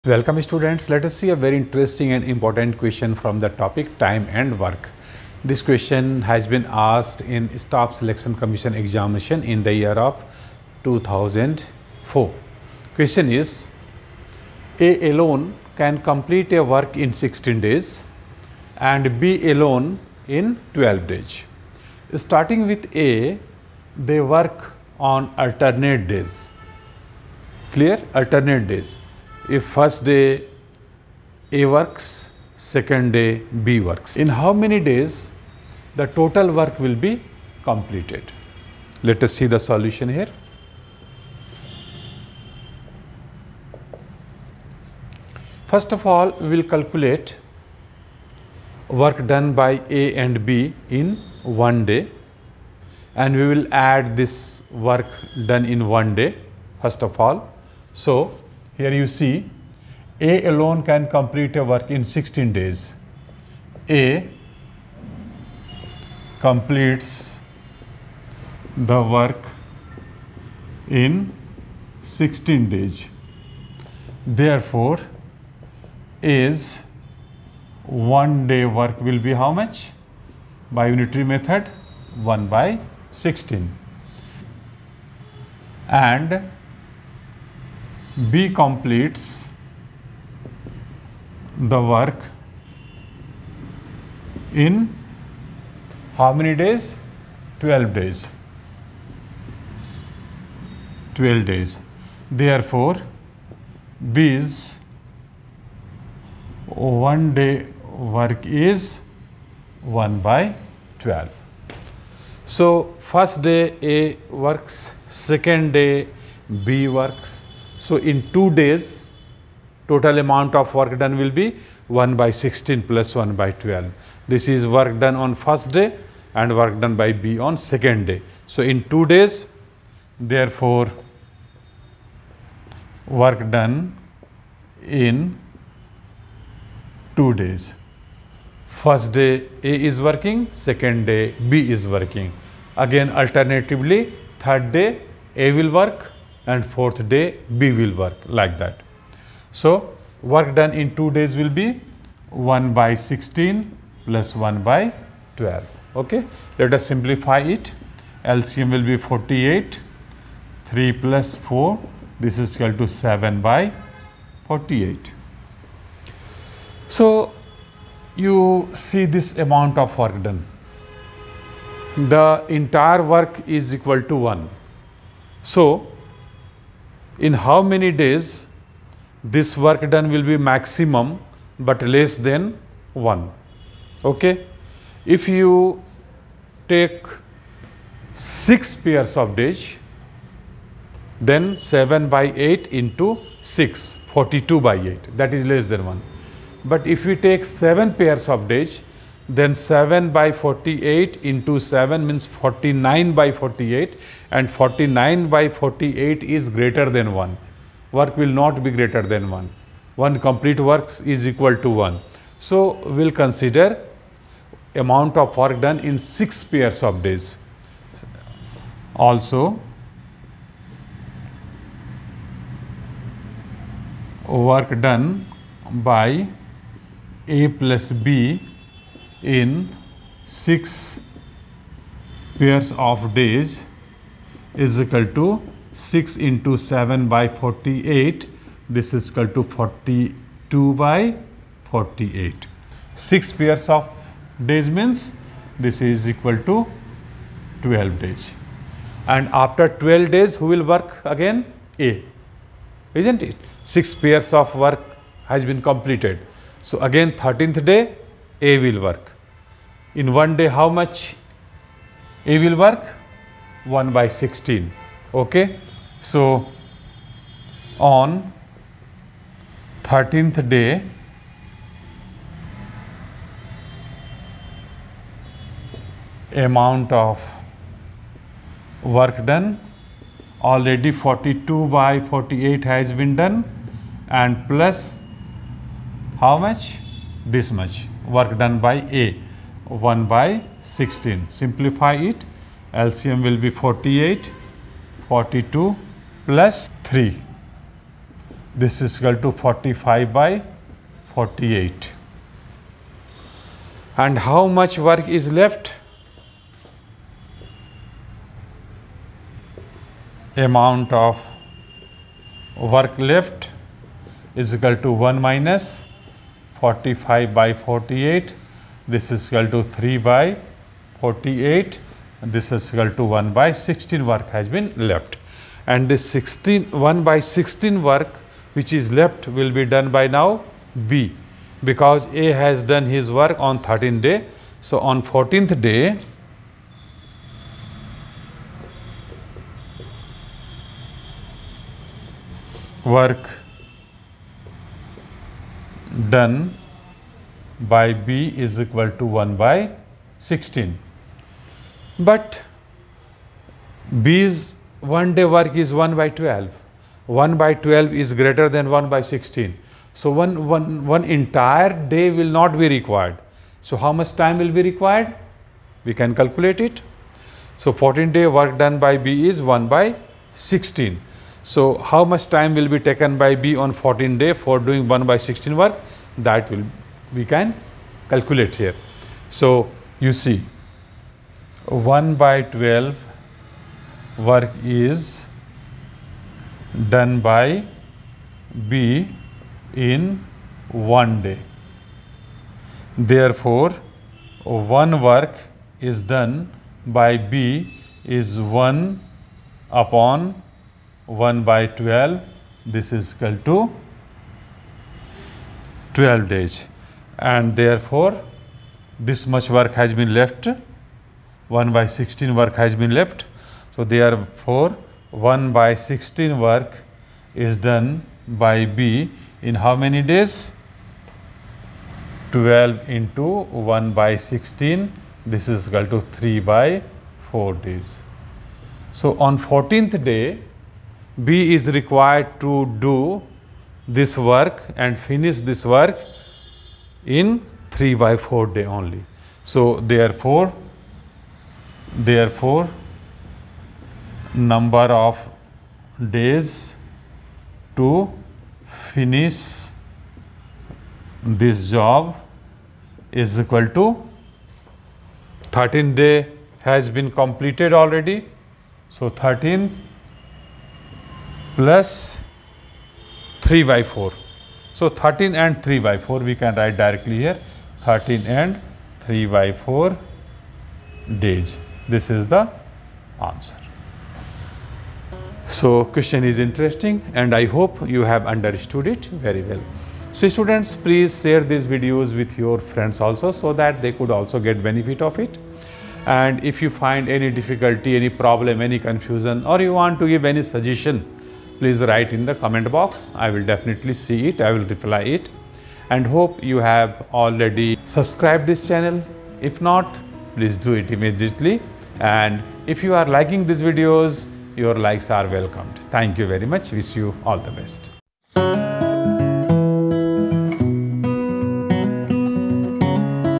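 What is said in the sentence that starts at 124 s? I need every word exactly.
This is work done on first day and work done by B on second day.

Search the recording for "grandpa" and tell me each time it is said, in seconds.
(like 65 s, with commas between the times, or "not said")
not said.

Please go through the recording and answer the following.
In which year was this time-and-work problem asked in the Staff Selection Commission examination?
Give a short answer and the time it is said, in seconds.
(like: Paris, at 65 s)
2004, at 10 s.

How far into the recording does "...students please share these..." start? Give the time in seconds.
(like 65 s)
480 s.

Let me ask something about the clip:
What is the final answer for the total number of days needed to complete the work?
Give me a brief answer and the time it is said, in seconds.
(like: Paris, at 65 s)
13 3/4 days, at 467 s.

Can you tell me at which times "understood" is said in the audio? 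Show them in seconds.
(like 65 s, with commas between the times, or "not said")
478 s.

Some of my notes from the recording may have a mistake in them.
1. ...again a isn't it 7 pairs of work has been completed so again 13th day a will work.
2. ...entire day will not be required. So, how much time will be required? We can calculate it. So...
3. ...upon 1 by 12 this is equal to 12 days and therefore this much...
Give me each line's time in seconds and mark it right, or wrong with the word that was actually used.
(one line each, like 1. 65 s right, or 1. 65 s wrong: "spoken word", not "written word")
1. 251 s wrong: "6", not "7"
2. 361 s right
3. 399 s right.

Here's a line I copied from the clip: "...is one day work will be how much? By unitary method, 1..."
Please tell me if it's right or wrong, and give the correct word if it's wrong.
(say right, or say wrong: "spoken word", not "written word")
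right.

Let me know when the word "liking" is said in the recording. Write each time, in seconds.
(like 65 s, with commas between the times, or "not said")
503 s.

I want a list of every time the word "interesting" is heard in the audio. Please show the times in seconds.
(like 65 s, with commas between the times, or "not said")
1 s, 476 s.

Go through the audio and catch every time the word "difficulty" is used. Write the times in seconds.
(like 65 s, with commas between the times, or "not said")
487 s.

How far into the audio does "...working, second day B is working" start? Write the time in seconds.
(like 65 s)
139 s.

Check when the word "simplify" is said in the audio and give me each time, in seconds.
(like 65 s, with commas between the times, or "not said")
156 s, 291 s.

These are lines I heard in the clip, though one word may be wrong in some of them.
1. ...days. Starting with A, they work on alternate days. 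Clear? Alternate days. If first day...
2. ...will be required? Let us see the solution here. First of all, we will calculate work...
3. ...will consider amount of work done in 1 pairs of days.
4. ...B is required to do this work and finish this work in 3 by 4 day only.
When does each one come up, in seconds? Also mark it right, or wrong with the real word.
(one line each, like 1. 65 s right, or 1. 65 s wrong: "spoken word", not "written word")
1. 21 s right
2. 36 s wrong: "completed", not "required"
3. 213 s wrong: "6", not "1"
4. 431 s right.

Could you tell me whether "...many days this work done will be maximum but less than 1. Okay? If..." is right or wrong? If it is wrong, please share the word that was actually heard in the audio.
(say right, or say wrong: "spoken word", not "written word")
right.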